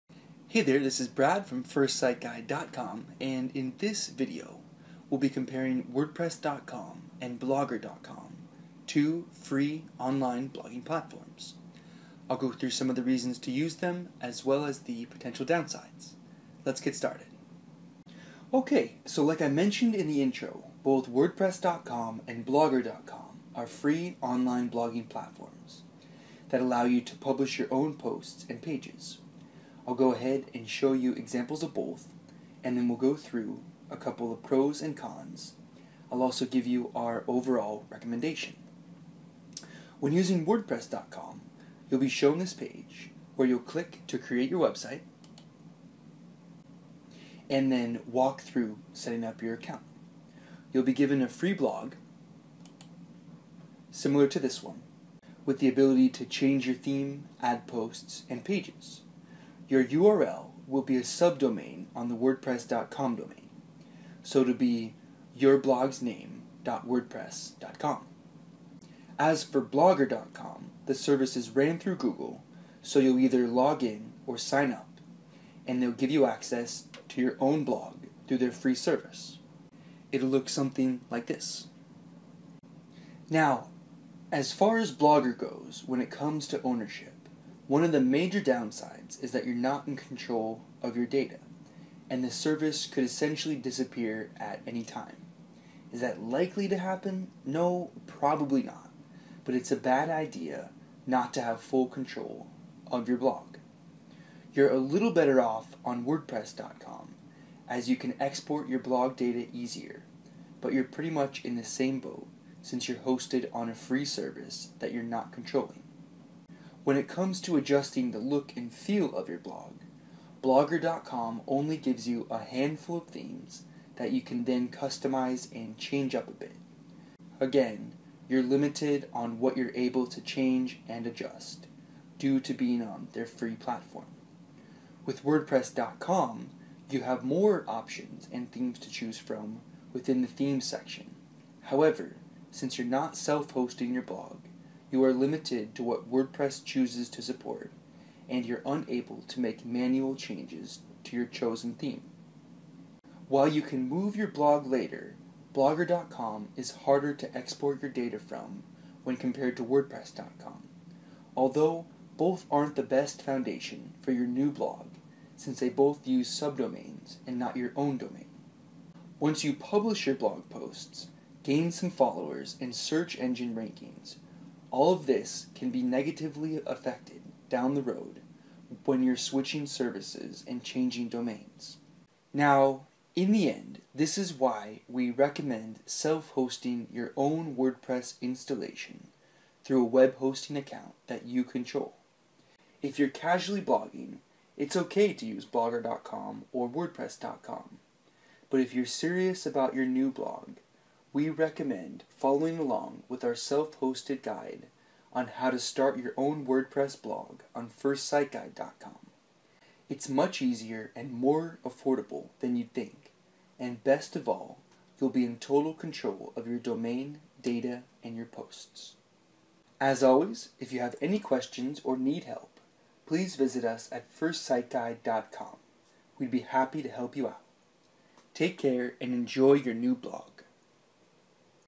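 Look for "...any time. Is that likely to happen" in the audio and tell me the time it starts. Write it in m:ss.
1:34.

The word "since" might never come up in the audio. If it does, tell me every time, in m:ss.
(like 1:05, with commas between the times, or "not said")
1:52, 2:22, 2:45.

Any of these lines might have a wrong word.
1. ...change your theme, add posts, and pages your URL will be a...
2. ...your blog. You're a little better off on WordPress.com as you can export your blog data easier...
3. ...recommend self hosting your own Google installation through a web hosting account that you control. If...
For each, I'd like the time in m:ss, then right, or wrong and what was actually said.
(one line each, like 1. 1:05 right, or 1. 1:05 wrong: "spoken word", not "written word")
1. 0:56 right
2. 1:43 right
3. 3:05 wrong: "WordPress", not "Google".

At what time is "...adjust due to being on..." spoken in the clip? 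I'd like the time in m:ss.
2:11.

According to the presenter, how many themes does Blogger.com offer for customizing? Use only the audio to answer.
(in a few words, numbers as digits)
a handful.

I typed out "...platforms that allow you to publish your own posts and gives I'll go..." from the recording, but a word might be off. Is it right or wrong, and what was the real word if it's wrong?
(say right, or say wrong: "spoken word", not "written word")
wrong: "pages", not "gives".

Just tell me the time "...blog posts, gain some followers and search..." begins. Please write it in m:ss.
2:50.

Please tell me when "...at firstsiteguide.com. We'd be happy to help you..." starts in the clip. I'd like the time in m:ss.
3:43.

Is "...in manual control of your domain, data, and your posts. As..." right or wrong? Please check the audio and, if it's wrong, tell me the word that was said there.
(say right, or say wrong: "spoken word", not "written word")
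wrong: "total", not "manual".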